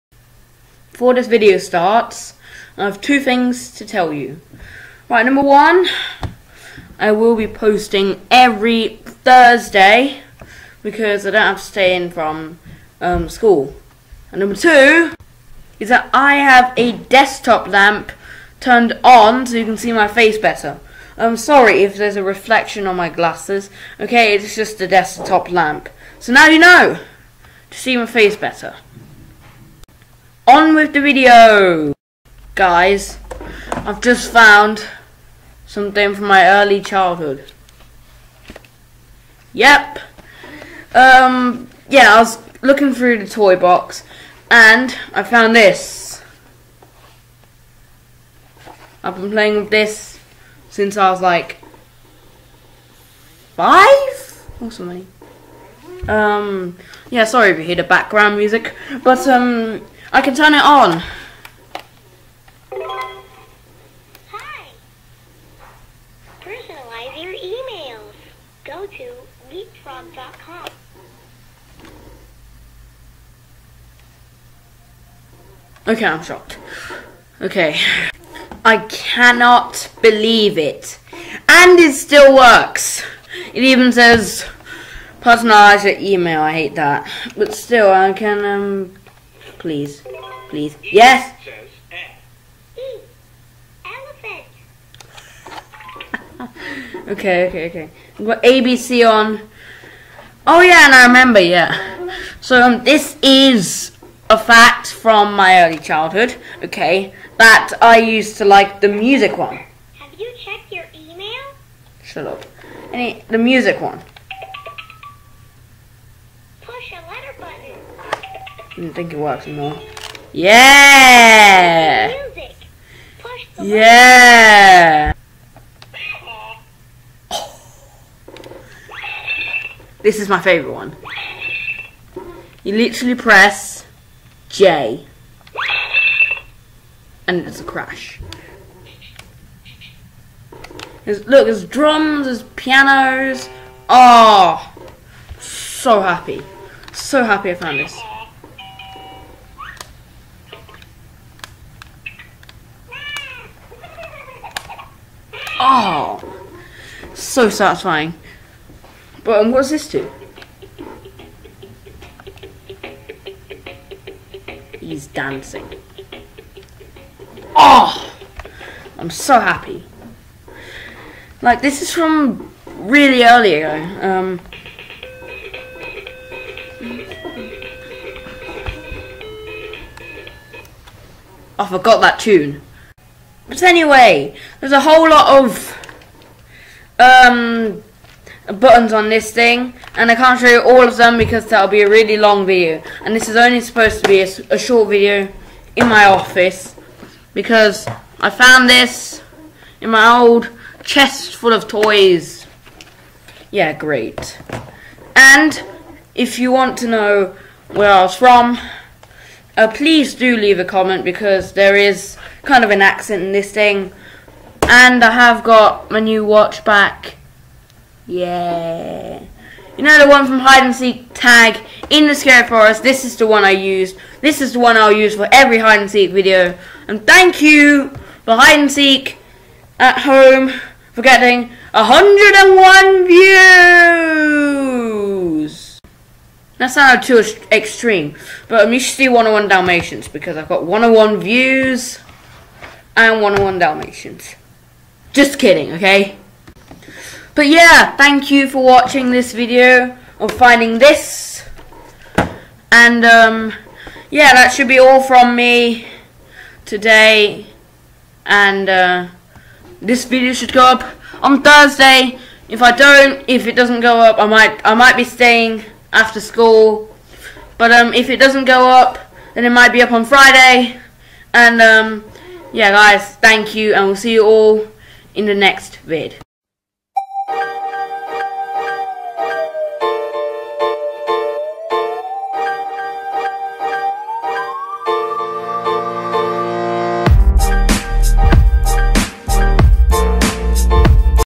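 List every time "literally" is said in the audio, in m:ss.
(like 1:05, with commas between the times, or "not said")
2:12.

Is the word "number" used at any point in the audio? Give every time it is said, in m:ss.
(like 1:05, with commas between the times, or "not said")
0:05, 0:14.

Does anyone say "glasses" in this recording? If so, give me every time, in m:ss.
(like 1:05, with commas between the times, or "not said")
0:23.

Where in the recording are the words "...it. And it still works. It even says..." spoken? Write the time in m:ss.
1:20.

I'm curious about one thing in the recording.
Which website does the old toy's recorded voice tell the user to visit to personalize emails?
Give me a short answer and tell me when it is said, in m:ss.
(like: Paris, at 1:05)
leapfrog.com, at 1:09.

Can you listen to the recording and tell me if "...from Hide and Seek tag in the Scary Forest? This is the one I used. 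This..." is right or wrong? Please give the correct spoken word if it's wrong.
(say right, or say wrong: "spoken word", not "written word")
right.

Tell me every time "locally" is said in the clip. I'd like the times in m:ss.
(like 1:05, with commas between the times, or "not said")
not said.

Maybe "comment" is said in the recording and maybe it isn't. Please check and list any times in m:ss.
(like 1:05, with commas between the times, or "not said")
3:30.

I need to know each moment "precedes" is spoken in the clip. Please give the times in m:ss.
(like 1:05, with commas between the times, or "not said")
not said.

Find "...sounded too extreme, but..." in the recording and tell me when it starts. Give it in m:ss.
3:56.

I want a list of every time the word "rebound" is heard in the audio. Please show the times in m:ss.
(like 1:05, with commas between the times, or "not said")
not said.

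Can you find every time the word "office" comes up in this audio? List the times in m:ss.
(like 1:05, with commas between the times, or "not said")
3:16.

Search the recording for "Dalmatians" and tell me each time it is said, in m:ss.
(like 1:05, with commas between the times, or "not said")
3:59, 4:03.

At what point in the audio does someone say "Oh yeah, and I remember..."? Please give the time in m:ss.
1:40.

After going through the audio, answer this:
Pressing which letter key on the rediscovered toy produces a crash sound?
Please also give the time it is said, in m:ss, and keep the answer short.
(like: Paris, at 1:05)
J, at 2:13.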